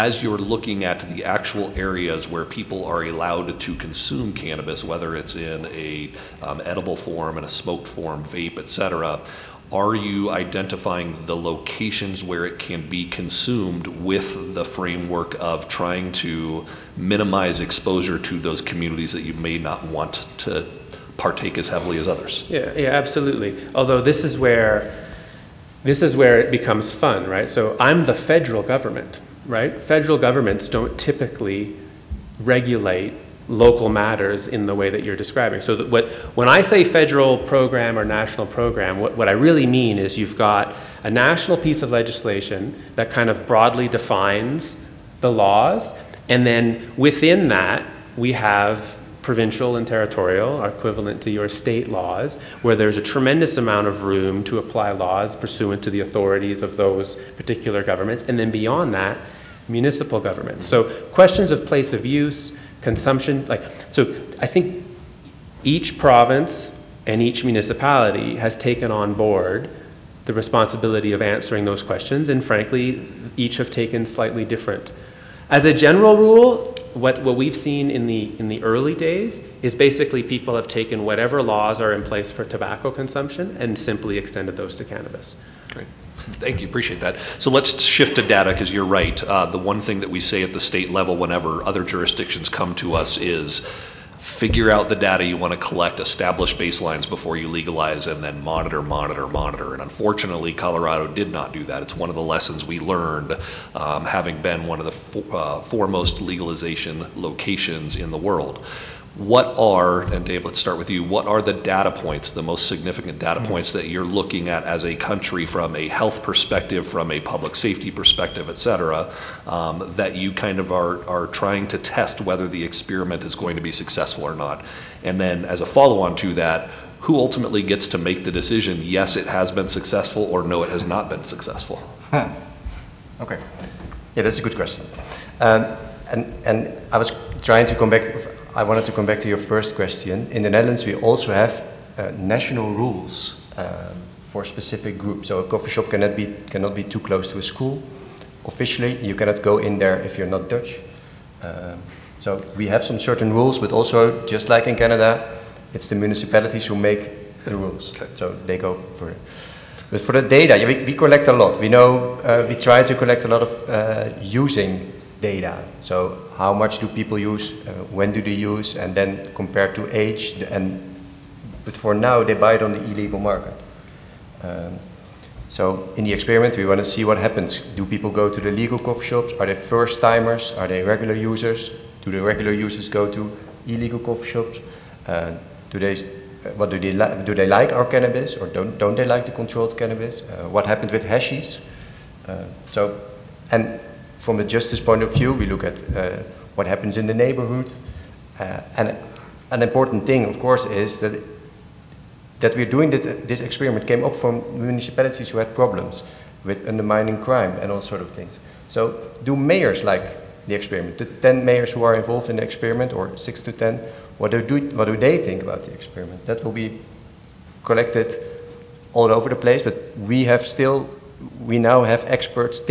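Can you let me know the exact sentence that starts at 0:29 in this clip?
Federal governments don't typically regulate local matters in the way that you're describing.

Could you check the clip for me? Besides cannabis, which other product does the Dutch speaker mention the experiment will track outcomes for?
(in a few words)
Hashish.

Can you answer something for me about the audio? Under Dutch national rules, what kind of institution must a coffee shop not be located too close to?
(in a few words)
A school.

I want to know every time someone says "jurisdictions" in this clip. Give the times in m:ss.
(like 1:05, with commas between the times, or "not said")
1:31.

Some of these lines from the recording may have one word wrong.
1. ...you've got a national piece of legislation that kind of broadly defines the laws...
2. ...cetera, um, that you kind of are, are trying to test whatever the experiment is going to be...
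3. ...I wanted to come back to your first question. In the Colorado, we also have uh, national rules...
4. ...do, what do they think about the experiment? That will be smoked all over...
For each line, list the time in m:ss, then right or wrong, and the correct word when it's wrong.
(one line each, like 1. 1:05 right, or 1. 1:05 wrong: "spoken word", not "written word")
1. 0:40 right
2. 1:58 wrong: "whether", not "whatever"
3. 2:18 wrong: "Netherlands", not "Colorado"
4. 3:34 wrong: "collected", not "smoked".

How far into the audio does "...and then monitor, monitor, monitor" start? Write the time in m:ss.
1:38.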